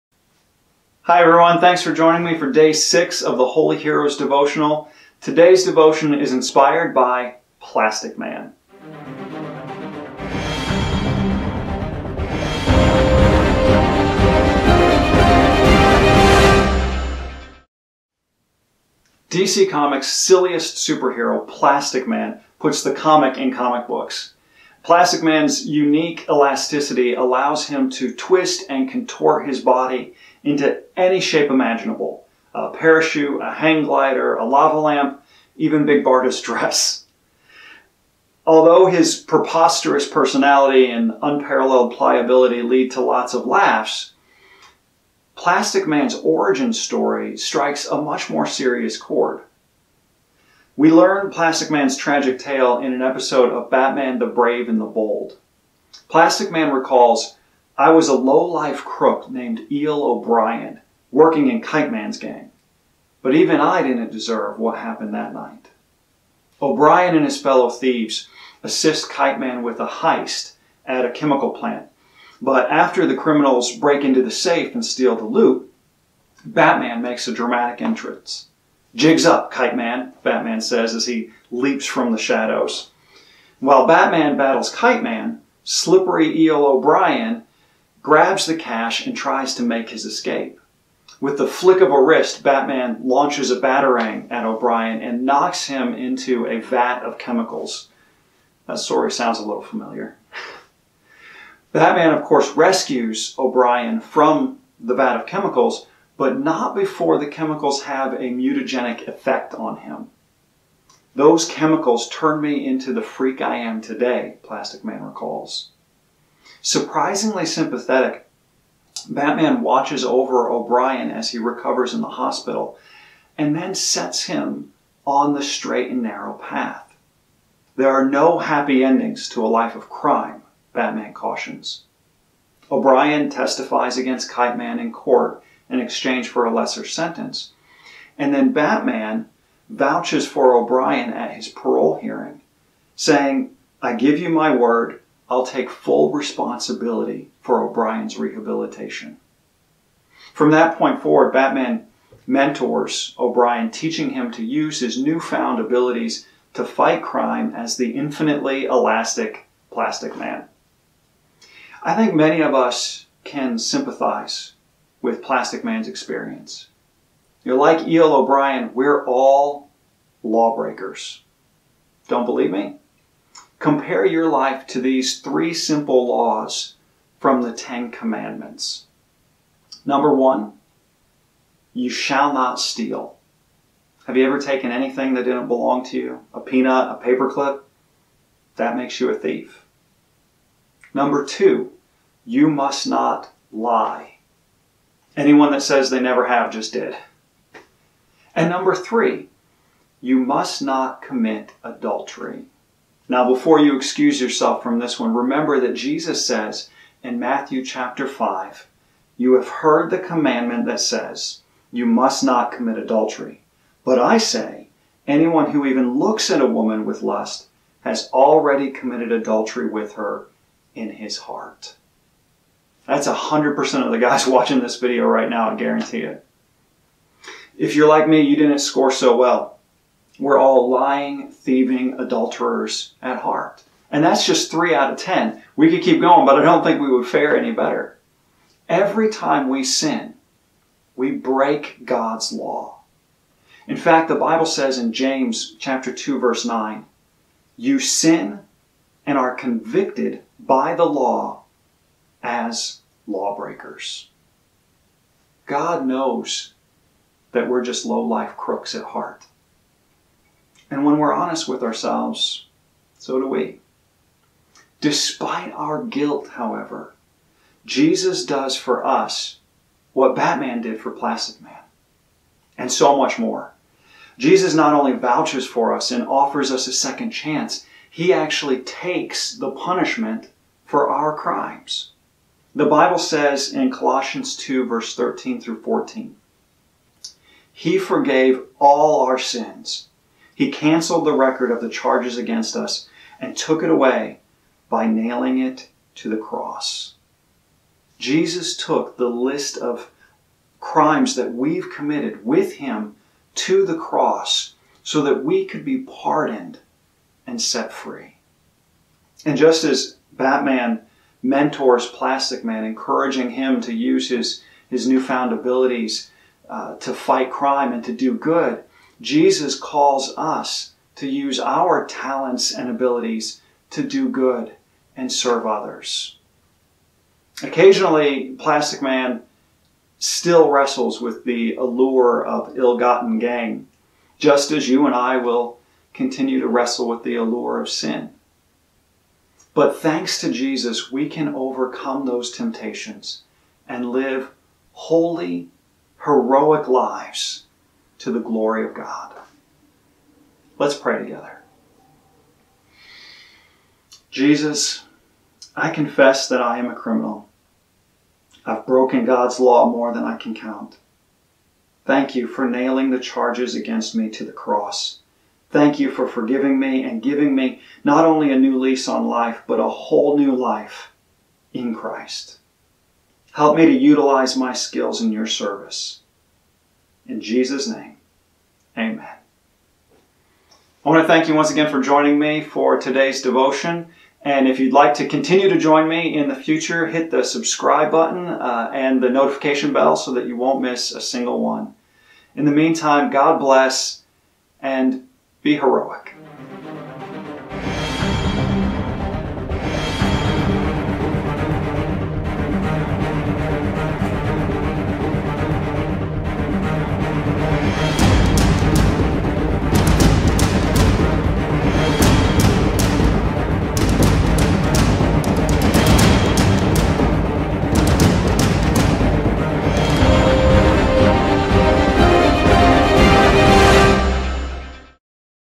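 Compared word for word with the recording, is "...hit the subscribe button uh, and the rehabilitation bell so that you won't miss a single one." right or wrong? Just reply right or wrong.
wrong.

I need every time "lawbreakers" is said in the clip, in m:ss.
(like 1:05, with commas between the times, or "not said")
2:50, 4:13.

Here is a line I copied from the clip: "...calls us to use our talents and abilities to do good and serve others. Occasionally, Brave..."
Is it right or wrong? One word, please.
wrong.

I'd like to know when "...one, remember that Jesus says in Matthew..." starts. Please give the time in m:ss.
3:25.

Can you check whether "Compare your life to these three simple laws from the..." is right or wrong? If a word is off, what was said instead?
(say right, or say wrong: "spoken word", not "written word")
right.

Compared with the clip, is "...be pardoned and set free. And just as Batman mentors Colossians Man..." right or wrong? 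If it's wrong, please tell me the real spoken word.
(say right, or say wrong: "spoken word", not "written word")
wrong: "Plastic", not "Colossians".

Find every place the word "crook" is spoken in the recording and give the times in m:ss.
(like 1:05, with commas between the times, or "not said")
0:58, 4:18.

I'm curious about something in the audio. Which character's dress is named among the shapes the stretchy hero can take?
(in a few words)
Big Barda.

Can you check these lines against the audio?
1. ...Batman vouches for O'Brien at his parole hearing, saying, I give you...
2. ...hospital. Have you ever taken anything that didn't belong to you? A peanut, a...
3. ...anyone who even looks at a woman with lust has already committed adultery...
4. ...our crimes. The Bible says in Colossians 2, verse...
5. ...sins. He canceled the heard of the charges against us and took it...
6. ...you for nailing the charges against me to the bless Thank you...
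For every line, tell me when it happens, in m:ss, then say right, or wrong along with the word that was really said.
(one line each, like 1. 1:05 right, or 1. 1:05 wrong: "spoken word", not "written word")
1. 2:18 right
2. 3:02 wrong: "steal", not "hospital"
3. 3:35 right
4. 4:40 right
5. 4:49 wrong: "record", not "heard"
6. 6:02 wrong: "cross", not "bless".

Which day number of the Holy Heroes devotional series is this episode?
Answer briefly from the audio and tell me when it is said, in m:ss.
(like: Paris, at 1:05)
6, at 0:02.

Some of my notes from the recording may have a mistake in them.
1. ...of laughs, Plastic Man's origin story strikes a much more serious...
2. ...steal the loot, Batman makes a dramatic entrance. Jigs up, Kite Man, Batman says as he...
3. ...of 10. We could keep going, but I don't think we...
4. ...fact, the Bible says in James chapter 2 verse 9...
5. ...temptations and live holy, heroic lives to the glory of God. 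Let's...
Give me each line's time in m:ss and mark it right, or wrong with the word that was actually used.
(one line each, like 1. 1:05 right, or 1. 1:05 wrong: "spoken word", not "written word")
1. 0:43 right
2. 1:14 right
3. 3:54 right
4. 4:03 right
5. 5:42 right.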